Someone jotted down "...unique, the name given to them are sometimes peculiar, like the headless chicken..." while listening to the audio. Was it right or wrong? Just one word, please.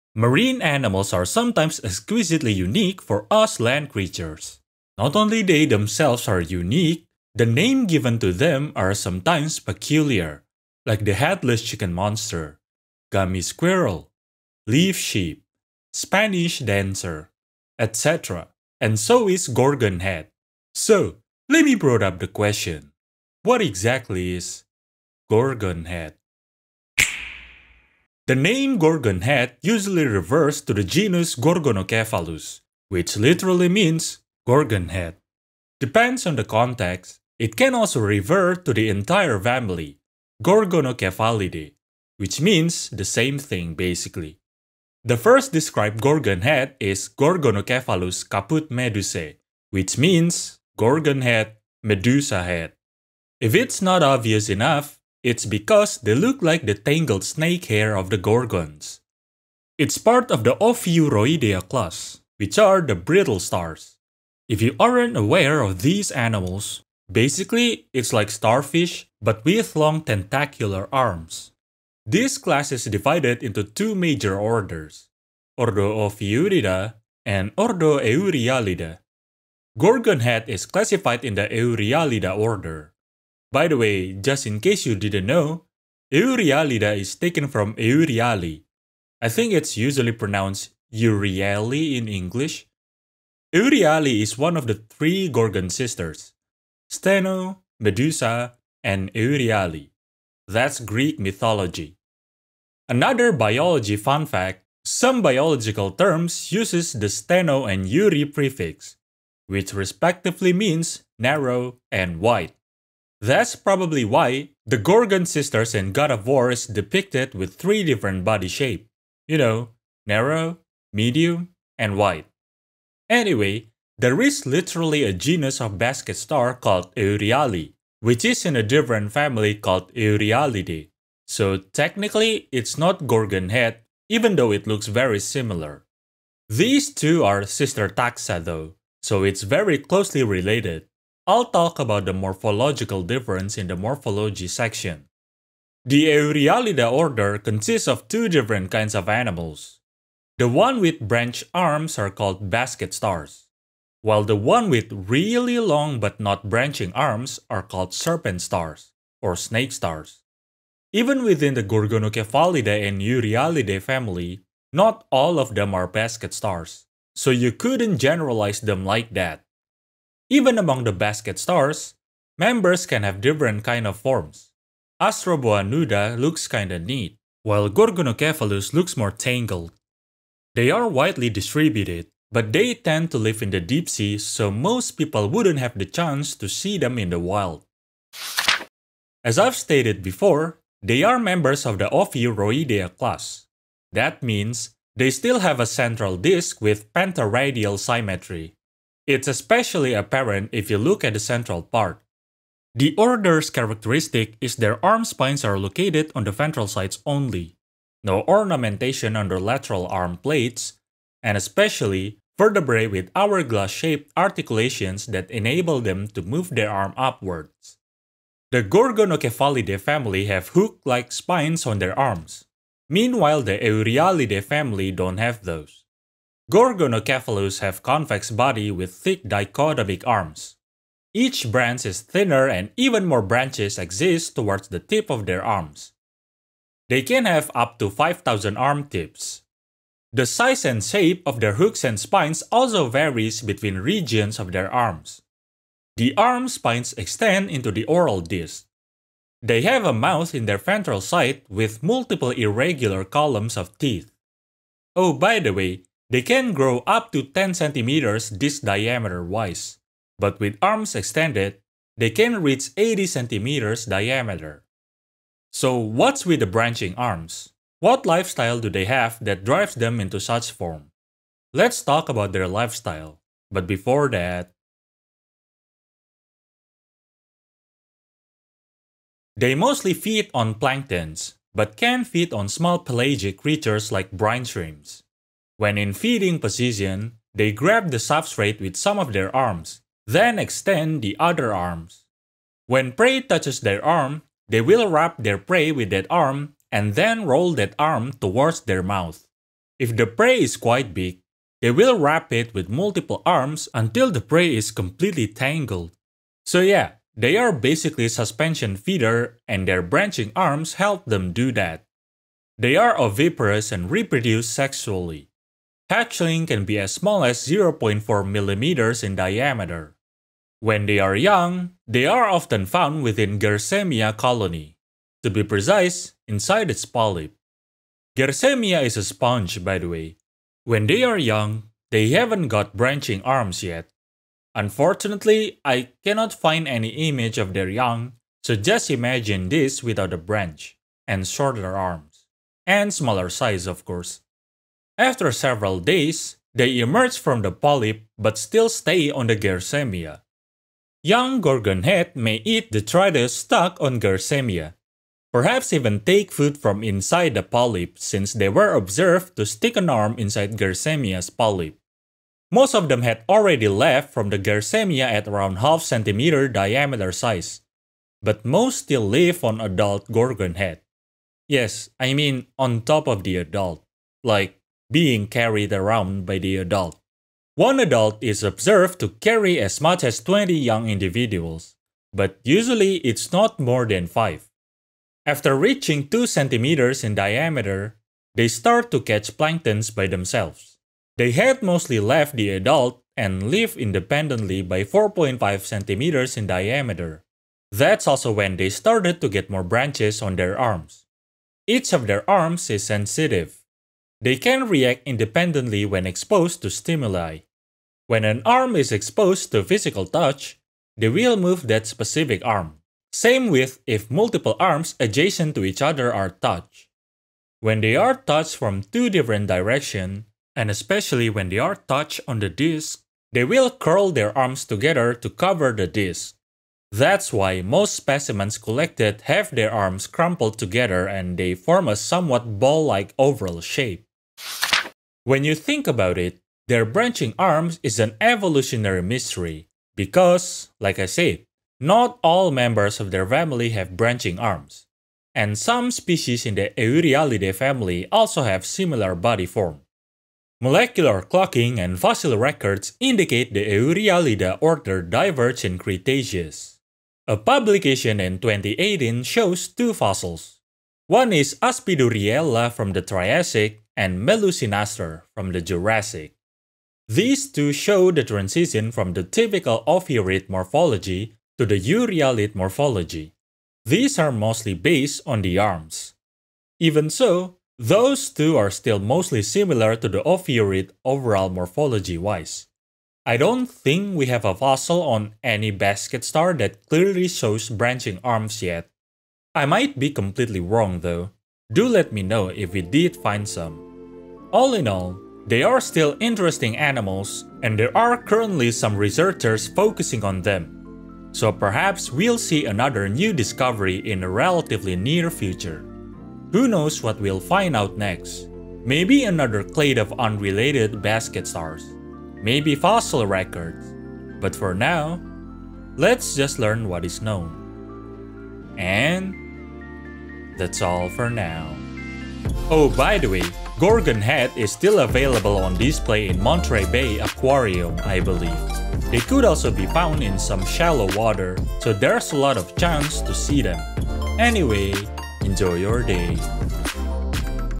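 right.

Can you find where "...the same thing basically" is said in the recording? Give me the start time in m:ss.
0:42.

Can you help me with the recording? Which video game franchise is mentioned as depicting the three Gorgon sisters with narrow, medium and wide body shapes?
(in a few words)
God of War.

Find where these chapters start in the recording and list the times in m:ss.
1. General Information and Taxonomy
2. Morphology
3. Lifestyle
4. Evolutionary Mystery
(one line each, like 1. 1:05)
1. 0:28
2. 3:09
3. 4:39
4. 7:15.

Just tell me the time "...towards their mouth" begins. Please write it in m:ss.
4:58.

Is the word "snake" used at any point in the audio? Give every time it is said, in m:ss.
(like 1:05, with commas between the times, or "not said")
0:57, 2:39.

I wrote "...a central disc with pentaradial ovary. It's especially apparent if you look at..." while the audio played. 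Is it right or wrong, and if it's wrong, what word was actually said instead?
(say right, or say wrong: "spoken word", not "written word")
wrong: "symmetry", not "ovary".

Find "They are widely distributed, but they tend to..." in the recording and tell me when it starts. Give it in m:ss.
3:00.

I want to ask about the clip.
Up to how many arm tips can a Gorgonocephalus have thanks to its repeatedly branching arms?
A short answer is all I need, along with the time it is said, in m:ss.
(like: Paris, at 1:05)
5000, at 3:57.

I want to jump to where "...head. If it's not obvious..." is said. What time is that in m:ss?
0:52.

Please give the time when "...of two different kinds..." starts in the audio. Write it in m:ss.
2:27.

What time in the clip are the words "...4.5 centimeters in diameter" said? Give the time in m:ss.
6:34.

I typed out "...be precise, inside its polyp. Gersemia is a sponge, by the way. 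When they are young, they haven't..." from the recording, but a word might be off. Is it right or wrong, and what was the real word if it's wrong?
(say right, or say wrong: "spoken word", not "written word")
right.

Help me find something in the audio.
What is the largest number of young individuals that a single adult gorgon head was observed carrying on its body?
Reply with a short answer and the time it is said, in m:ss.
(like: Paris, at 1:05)
20, at 6:20.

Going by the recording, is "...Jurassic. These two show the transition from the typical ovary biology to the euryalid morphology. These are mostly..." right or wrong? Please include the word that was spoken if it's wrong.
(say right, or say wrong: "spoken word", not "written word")
wrong: "morphology", not "biology".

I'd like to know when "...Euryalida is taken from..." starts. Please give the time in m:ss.
1:26.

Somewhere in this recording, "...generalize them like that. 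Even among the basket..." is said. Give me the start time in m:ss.
2:47.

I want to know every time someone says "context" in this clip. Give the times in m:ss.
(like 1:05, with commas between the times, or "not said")
0:36.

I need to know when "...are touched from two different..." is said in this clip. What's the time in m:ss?
6:57.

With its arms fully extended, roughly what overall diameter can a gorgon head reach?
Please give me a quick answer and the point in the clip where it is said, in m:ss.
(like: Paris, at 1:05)
80 centimeters, at 4:22.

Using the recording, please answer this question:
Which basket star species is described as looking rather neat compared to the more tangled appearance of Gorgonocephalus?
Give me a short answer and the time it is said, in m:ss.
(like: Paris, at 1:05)
Astroboa nuda, at 2:55.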